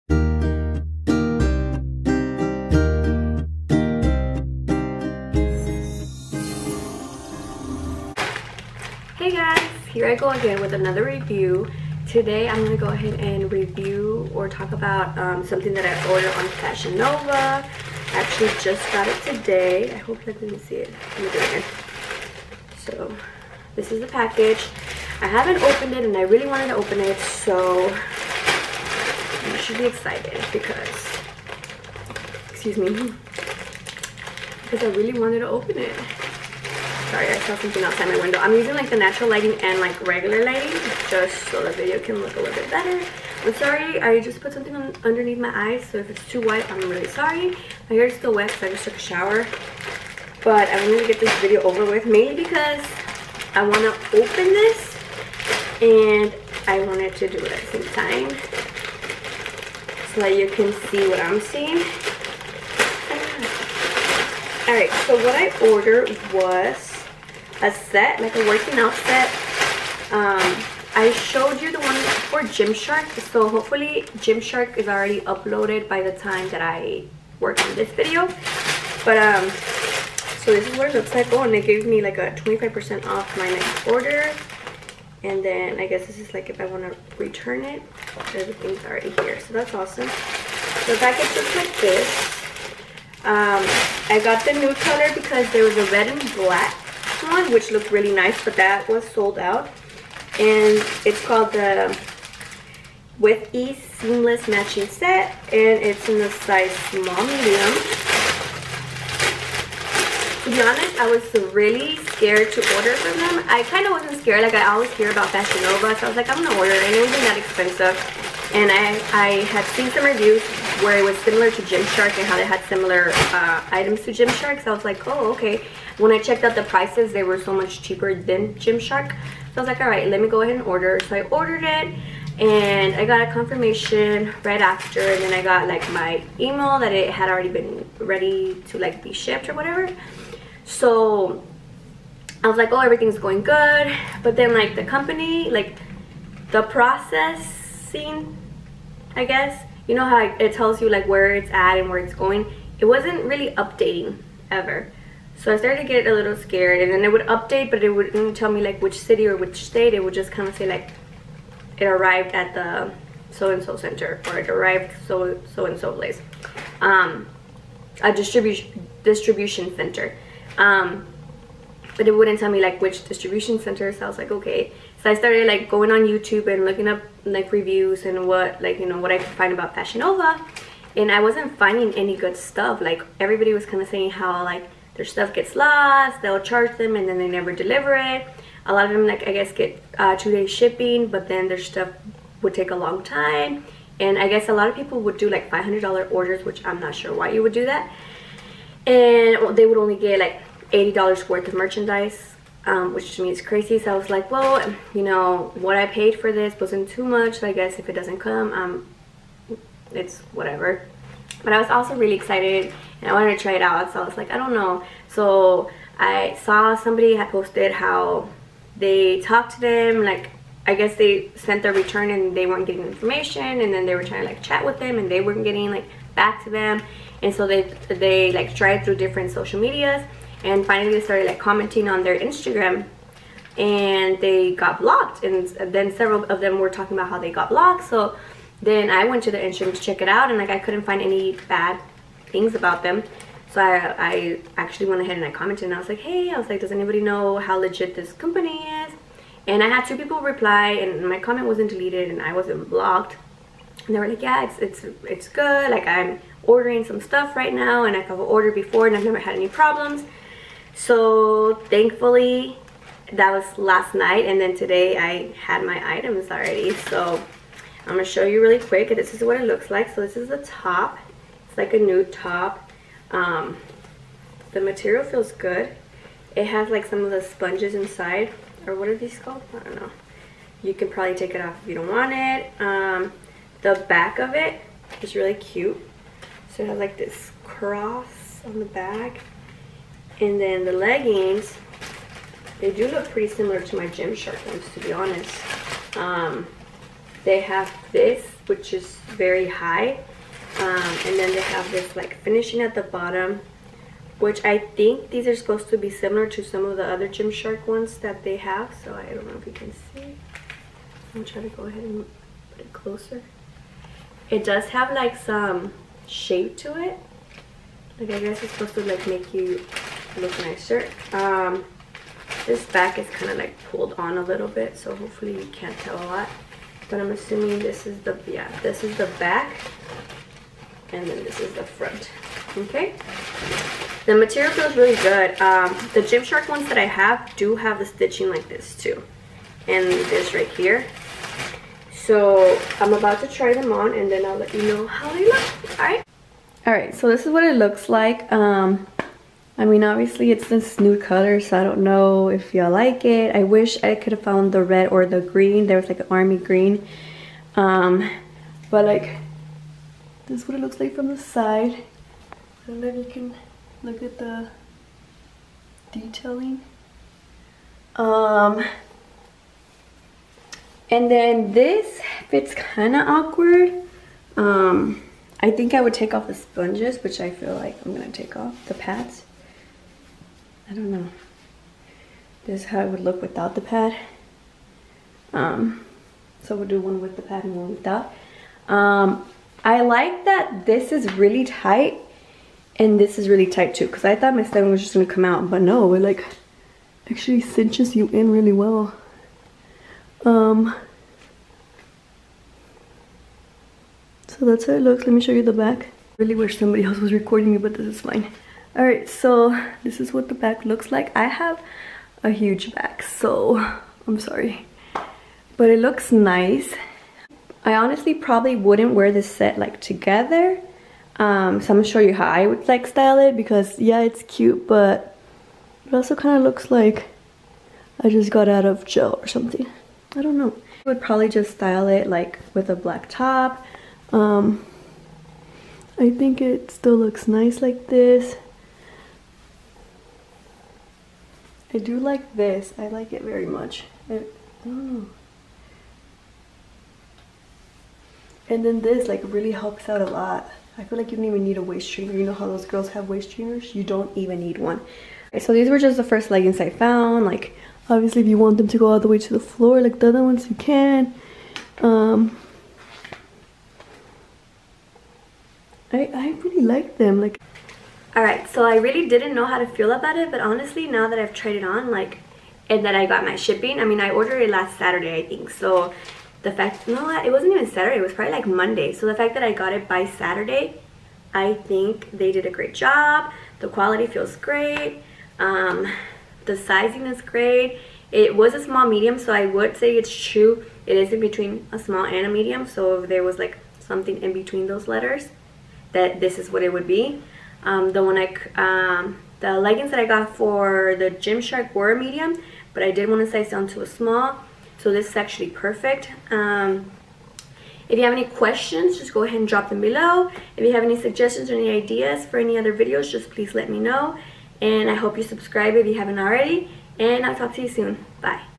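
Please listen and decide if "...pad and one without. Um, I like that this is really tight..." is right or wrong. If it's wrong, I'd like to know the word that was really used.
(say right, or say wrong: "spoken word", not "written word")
right.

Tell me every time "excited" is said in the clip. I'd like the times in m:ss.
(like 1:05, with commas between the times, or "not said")
0:29, 3:32.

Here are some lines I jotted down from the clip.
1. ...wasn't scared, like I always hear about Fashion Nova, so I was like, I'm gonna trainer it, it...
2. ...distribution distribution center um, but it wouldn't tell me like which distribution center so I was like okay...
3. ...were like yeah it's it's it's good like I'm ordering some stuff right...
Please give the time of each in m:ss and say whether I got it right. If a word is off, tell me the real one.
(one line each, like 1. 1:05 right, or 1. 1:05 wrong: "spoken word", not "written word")
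1. 1:53 wrong: "order", not "trainer"
2. 2:48 right
3. 4:13 right.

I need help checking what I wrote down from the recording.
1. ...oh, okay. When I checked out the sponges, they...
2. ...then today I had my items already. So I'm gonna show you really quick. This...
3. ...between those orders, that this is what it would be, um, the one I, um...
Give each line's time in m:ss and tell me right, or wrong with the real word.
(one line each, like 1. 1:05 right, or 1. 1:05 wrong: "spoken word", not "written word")
1. 2:05 wrong: "prices", not "sponges"
2. 4:24 right
3. 8:14 wrong: "letters", not "orders".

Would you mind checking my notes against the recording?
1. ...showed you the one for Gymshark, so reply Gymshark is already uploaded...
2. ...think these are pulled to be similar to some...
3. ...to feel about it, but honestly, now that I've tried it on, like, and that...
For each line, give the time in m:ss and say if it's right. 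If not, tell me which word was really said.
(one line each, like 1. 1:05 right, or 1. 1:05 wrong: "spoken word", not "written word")
1. 1:11 wrong: "hopefully", not "reply"
2. 5:04 wrong: "supposed", not "pulled"
3. 7:49 right.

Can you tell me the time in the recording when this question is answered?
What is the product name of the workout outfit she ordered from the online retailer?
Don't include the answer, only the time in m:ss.
1:43.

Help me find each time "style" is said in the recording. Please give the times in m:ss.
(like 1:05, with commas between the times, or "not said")
7:02, 7:11.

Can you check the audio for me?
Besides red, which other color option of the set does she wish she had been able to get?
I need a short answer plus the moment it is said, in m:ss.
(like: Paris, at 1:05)
army green, at 5:56.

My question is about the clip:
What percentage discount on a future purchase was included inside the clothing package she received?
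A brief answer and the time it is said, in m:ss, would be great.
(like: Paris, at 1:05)
25%, at 1:22.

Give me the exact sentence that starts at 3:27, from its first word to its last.
So I guess if it doesn't come, um, it's whatever.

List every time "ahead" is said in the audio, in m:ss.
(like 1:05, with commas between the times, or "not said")
0:12, 2:10, 4:05, 5:11, 8:29.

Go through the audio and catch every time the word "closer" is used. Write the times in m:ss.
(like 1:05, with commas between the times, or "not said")
5:12.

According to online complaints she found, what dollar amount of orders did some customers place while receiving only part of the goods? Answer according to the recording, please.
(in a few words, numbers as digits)
$500.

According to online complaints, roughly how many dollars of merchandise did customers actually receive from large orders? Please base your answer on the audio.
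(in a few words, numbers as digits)
$80.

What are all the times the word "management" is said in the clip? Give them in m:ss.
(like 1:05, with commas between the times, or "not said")
not said.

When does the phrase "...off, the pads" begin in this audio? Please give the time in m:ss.
6:18.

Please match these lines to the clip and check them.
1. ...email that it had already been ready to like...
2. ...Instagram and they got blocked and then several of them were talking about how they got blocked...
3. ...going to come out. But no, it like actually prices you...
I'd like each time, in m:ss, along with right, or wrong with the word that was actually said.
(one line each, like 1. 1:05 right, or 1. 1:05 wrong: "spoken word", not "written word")
1. 2:16 right
2. 3:52 right
3. 6:34 wrong: "cinches", not "prices".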